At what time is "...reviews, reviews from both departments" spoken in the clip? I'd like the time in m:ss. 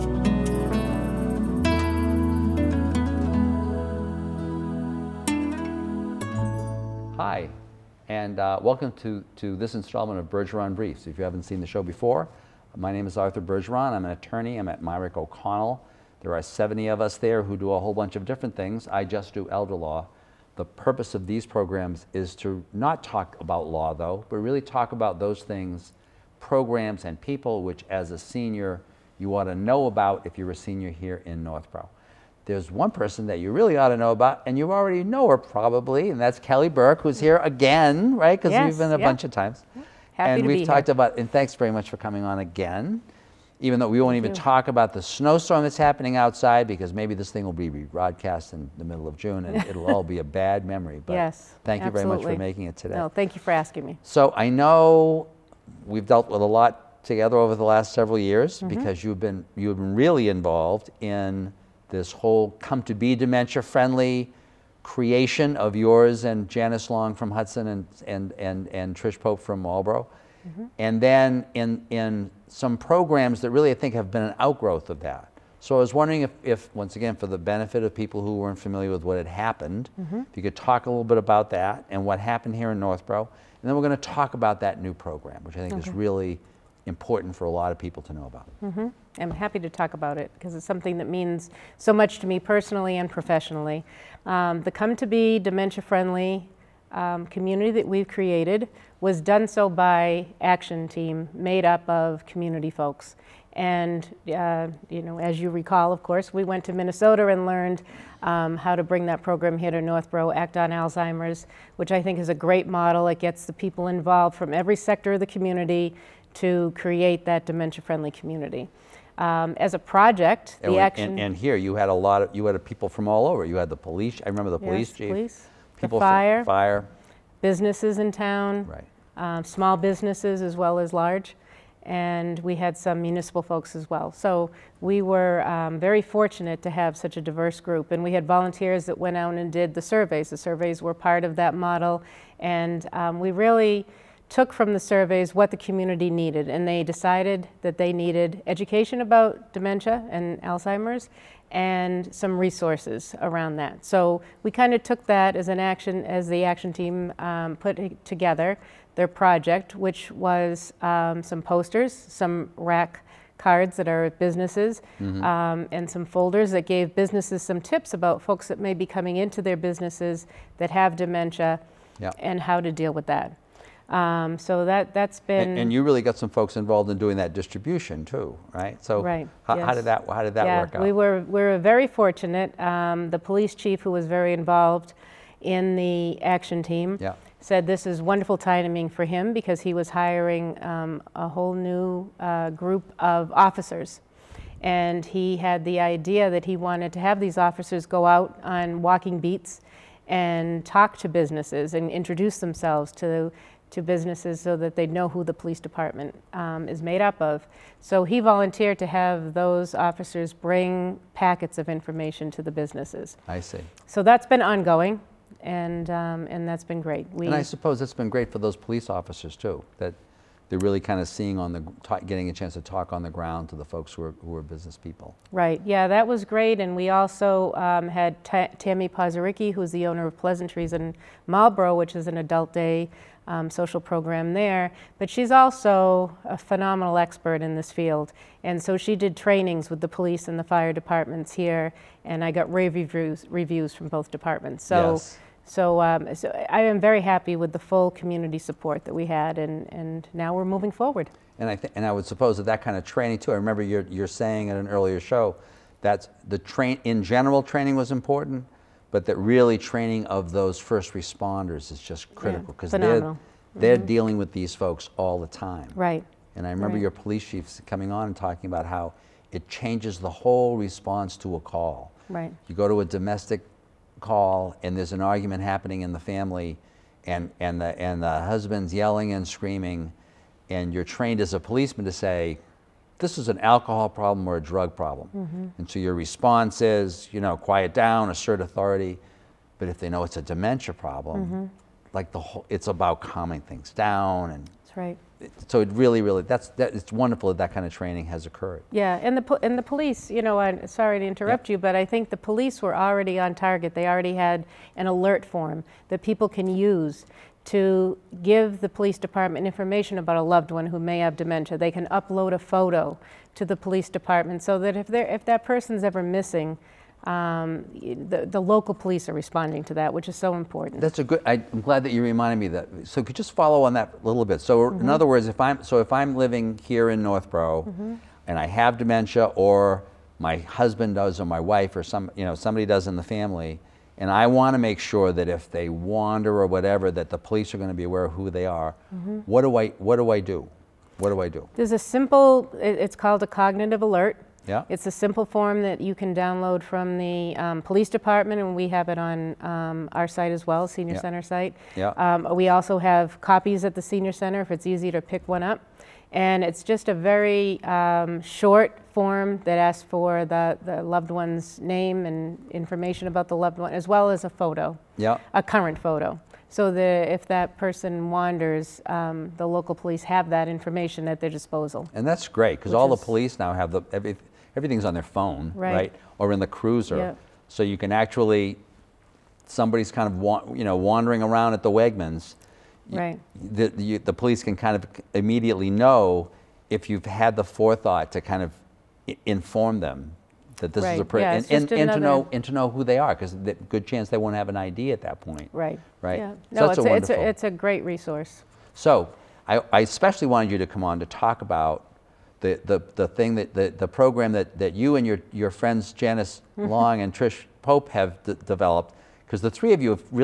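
4:02.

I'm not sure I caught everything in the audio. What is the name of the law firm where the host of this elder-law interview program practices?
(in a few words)
Mirick O'Connell.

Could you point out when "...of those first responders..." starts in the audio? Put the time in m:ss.
4:20.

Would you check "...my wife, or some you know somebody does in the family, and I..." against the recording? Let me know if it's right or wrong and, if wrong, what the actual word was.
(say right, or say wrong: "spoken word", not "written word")
right.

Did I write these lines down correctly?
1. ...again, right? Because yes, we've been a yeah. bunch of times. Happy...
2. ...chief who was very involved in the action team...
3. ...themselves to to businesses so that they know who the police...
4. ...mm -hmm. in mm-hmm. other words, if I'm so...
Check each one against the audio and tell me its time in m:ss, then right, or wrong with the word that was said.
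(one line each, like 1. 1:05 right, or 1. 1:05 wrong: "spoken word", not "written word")
1. 0:37 right
2. 3:03 right
3. 3:22 right
4. 5:24 right.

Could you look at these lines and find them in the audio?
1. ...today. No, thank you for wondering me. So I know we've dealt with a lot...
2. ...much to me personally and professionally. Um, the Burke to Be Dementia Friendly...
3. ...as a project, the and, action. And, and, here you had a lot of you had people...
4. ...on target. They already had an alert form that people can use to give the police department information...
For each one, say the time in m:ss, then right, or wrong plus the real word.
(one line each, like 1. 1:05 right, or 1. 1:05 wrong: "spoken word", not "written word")
1. 0:52 wrong: "asking", not "wondering"
2. 1:31 wrong: "Come", not "Burke"
3. 1:59 right
4. 5:03 right.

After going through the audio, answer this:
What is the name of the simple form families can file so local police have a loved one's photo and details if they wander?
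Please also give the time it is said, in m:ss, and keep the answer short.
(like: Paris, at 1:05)
cognitive alert, at 5:43.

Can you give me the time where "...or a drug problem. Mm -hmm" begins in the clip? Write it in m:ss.
4:44.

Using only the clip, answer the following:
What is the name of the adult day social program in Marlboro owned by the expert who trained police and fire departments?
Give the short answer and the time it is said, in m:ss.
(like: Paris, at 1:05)
Pleasantries, at 3:50.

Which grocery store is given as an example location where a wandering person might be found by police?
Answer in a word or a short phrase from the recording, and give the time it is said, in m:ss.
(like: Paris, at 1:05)
Wegmans, at 6:21.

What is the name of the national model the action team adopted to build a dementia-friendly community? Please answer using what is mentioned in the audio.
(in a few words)
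Act on Alzheimer's.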